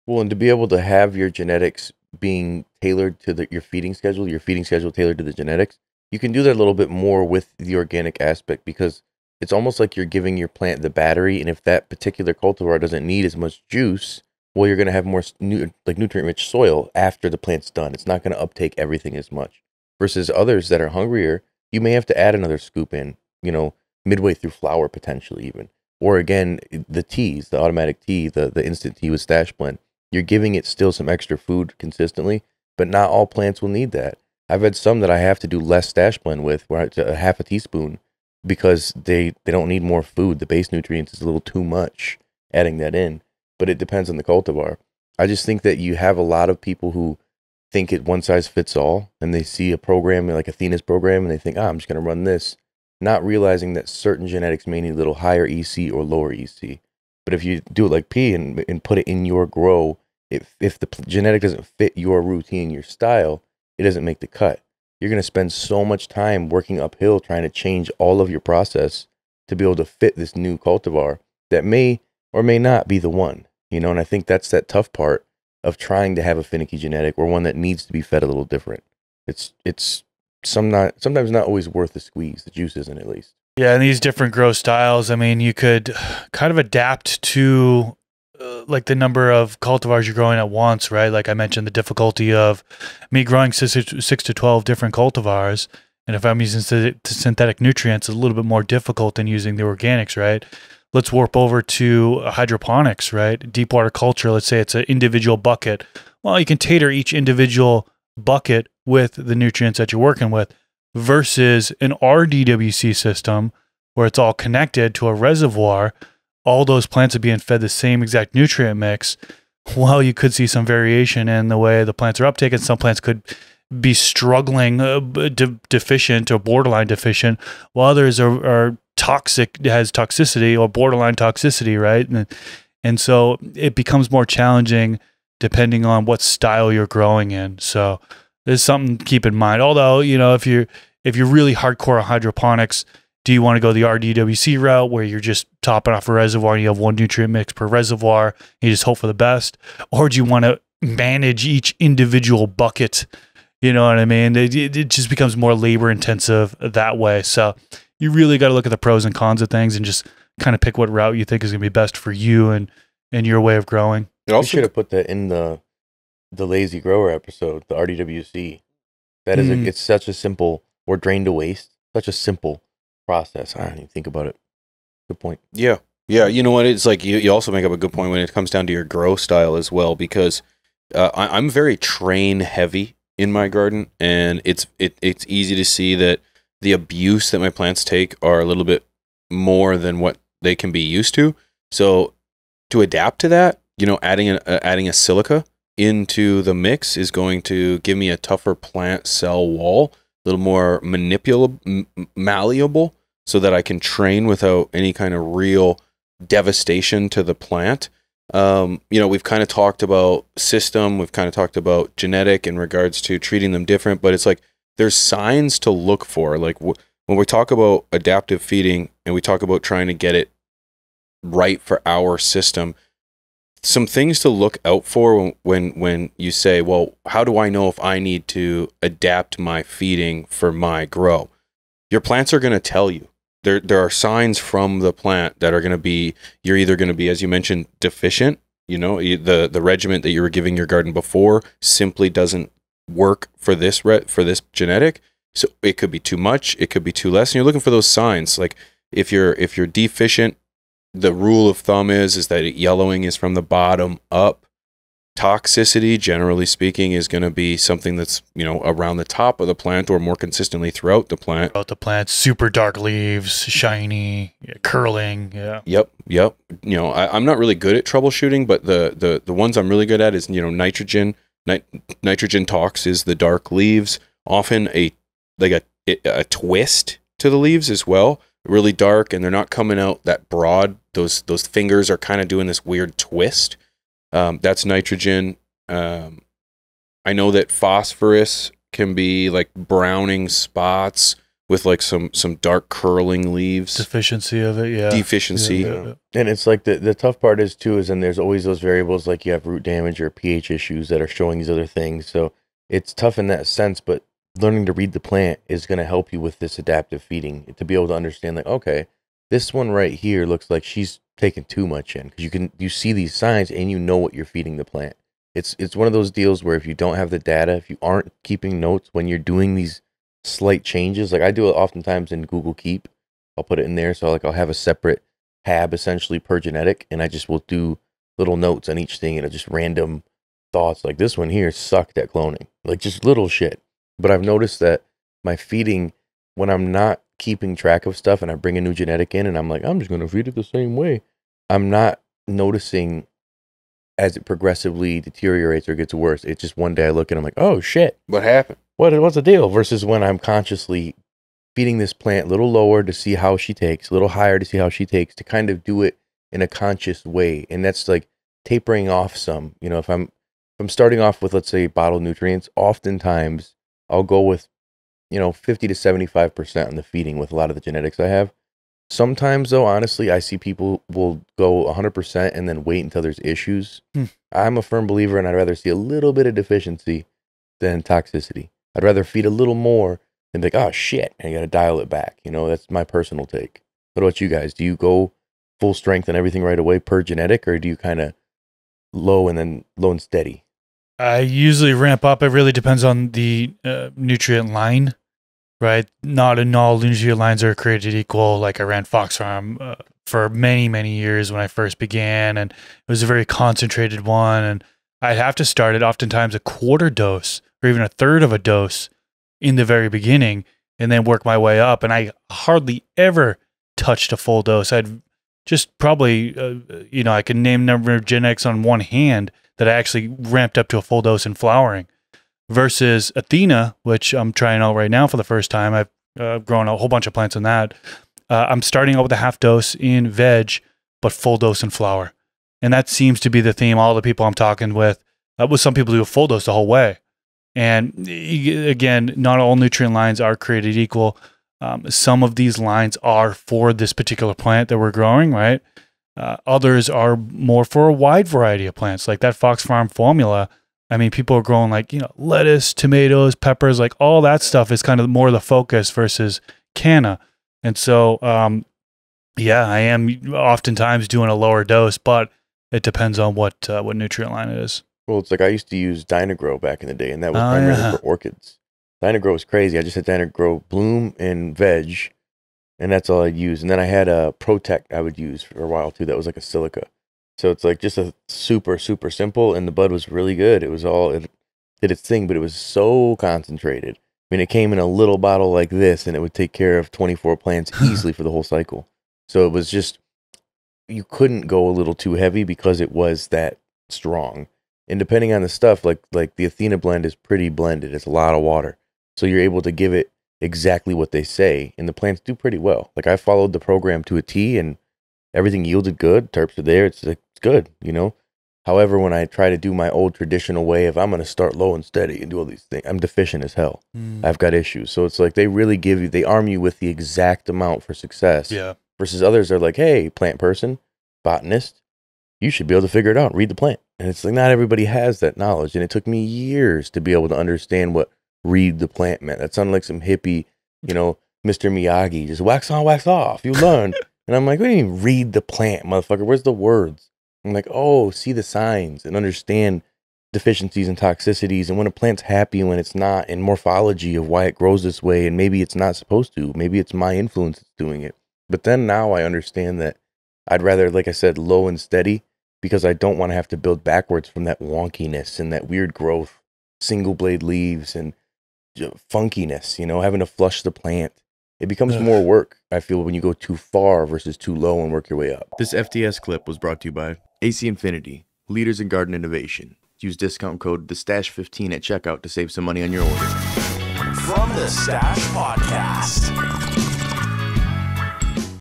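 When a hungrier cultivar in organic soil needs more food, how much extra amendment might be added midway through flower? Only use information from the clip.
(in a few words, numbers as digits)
another scoop.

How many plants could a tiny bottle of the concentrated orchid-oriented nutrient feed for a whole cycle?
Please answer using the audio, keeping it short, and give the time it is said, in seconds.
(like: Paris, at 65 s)
24, at 486 s.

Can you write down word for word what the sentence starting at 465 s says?
Well, it's like I used to use Dyna-Gro back in the day, and that was oh, primarily yeah.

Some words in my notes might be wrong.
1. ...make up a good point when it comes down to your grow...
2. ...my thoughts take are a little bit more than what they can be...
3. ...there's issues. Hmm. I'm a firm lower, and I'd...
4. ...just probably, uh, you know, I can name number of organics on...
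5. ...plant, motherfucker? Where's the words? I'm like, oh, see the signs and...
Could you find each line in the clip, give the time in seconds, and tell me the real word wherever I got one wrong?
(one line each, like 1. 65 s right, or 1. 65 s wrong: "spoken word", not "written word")
1. 177 s right
2. 187 s wrong: "plants", not "thoughts"
3. 373 s wrong: "believer", not "lower"
4. 415 s wrong: "genetics", not "organics"
5. 535 s right.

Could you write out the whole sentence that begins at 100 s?
Let's warp over to hydroponics, right?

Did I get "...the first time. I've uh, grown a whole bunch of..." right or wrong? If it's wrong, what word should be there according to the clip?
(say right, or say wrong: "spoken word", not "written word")
right.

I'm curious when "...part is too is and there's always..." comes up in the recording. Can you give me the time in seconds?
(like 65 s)
297 s.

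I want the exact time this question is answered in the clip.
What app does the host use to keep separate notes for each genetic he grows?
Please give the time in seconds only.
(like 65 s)
322 s.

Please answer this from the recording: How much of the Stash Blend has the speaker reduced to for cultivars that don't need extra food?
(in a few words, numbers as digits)
half a teaspoon.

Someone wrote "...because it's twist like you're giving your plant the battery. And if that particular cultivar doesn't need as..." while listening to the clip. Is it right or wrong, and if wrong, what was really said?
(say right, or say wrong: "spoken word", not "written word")
wrong: "almost", not "twist".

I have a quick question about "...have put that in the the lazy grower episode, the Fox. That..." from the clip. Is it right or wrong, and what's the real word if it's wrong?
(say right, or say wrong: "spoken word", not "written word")
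wrong: "RDWC", not "Fox".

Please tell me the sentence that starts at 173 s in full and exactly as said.
I do not even think about it.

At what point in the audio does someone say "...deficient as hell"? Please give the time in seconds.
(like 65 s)
512 s.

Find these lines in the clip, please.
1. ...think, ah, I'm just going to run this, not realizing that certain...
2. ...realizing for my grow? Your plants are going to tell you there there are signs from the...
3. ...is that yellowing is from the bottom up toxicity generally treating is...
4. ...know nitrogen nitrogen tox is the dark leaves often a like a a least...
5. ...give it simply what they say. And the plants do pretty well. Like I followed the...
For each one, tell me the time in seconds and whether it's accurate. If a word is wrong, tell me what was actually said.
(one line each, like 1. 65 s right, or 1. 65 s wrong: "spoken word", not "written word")
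1. 51 s right
2. 229 s wrong: "feeding", not "realizing"
3. 252 s wrong: "speaking", not "treating"
4. 270 s wrong: "twist", not "least"
5. 499 s wrong: "exactly", not "simply".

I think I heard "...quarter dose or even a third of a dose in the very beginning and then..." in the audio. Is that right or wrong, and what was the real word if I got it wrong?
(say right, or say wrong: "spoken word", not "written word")
right.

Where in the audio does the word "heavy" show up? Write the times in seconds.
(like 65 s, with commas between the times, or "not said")
182 s, 492 s.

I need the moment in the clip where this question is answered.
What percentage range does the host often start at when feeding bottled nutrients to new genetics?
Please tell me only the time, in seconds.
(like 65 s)
365 s.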